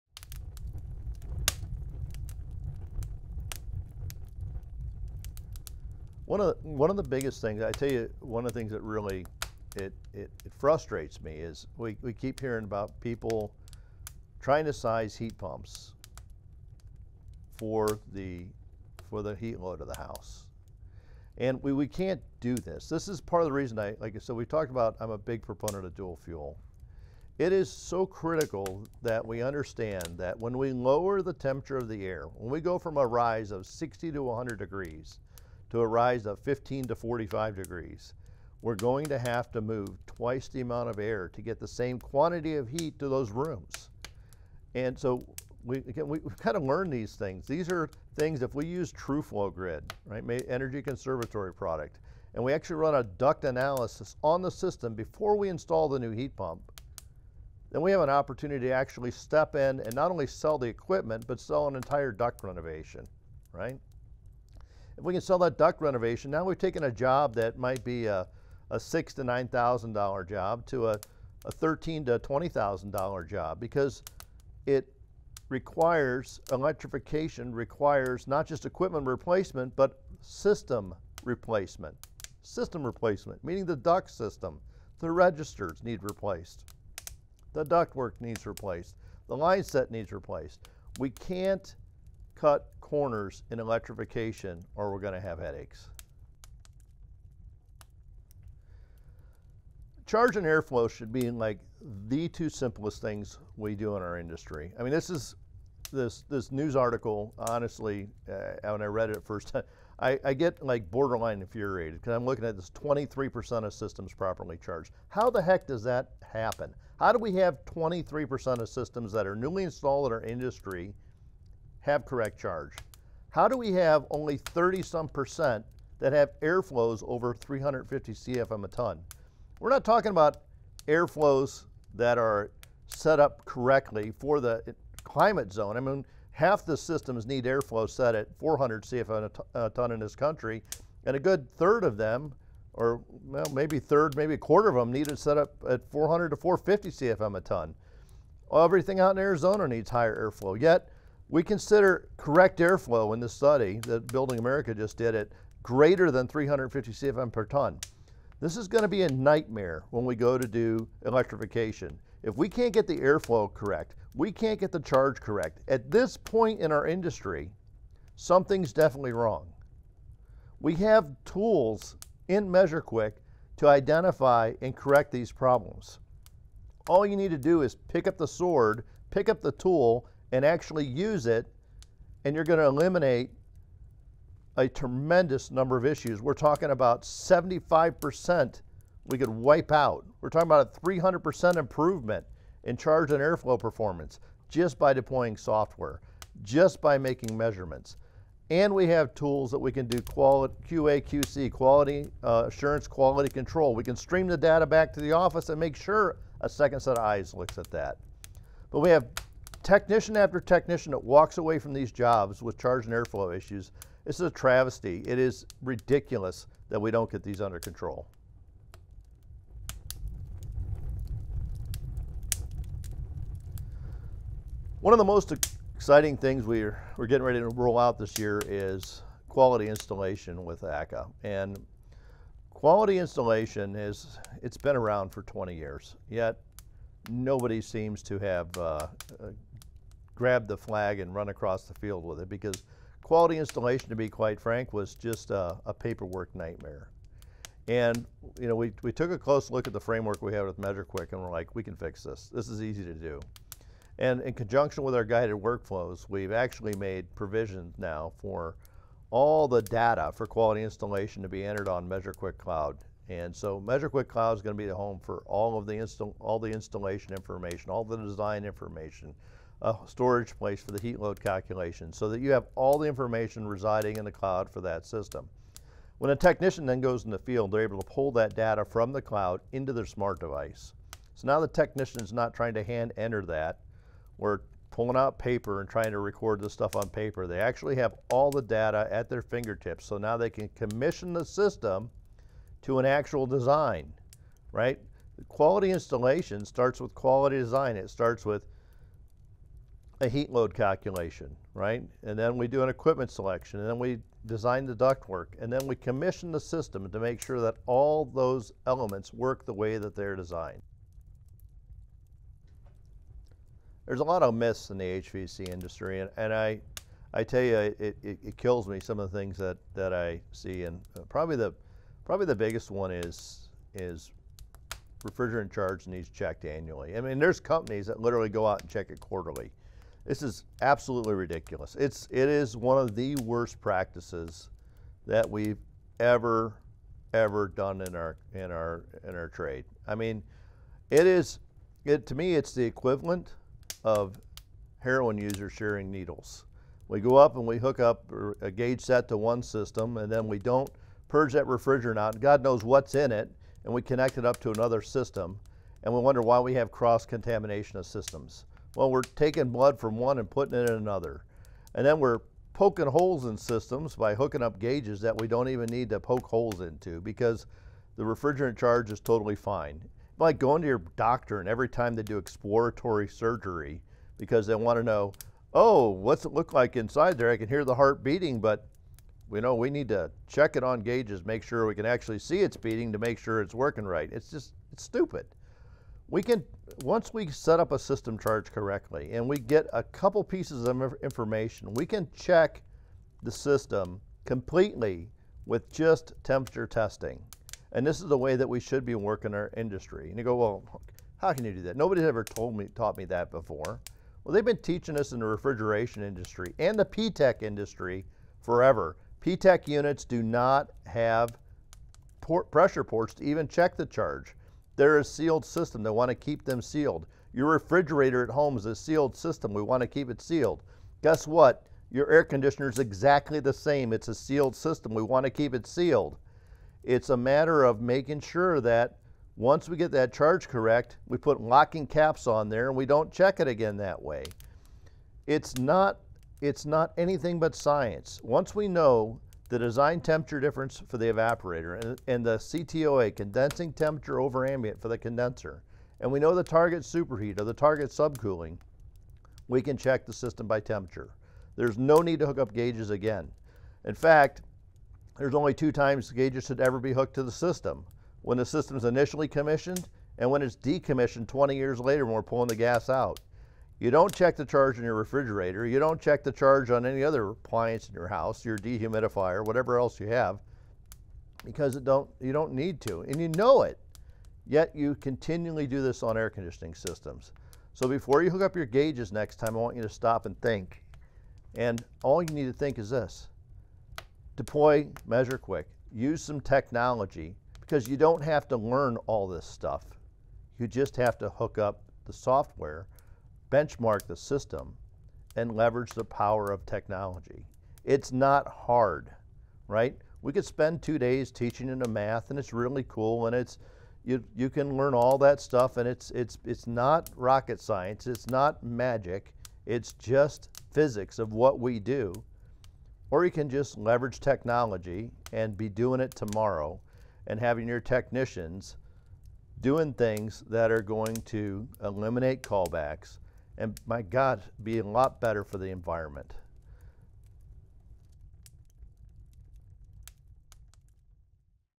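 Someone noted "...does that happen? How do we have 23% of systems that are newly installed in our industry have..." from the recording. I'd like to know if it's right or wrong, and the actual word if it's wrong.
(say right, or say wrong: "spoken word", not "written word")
right.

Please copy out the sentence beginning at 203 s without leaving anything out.
We can stream the data back to the office and make sure a second set of eyes looks at that.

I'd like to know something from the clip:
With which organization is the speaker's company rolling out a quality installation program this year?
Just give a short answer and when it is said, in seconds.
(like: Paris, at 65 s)
ACCA, at 230 s.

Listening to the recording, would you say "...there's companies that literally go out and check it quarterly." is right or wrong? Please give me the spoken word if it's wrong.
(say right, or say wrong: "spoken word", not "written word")
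right.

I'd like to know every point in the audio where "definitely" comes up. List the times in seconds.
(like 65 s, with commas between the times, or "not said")
168 s.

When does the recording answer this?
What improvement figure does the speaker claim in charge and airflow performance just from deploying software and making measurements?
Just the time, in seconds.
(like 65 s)
190 s.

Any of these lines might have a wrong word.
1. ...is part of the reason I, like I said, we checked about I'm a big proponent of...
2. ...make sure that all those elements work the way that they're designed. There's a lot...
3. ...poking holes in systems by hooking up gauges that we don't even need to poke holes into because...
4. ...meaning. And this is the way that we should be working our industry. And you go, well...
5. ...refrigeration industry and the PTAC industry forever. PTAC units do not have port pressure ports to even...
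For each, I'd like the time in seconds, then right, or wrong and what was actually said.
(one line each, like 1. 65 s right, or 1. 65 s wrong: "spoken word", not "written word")
1. 23 s wrong: "talked", not "checked"
2. 306 s right
3. 362 s right
4. 396 s wrong: "testing", not "meaning"
5. 405 s right.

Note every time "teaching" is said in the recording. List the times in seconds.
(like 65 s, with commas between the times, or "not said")
404 s, 501 s.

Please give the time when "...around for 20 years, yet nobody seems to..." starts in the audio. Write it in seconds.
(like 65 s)
234 s.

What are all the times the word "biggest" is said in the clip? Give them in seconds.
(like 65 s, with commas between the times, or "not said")
7 s, 322 s.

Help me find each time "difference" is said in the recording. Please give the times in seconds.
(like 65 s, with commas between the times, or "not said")
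440 s.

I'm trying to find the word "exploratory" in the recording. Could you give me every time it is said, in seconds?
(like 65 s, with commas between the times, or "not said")
372 s.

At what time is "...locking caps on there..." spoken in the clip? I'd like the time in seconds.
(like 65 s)
431 s.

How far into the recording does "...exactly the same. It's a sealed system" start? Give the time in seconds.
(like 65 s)
422 s.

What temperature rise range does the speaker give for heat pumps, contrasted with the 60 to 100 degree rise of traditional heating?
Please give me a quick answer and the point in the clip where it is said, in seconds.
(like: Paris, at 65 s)
15 to 45 degrees, at 36 s.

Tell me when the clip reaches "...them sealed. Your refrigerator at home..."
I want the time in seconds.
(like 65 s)
416 s.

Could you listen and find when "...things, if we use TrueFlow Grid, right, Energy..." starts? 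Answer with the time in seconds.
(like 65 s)
48 s.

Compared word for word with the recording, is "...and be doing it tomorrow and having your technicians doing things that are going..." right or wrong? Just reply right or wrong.
right.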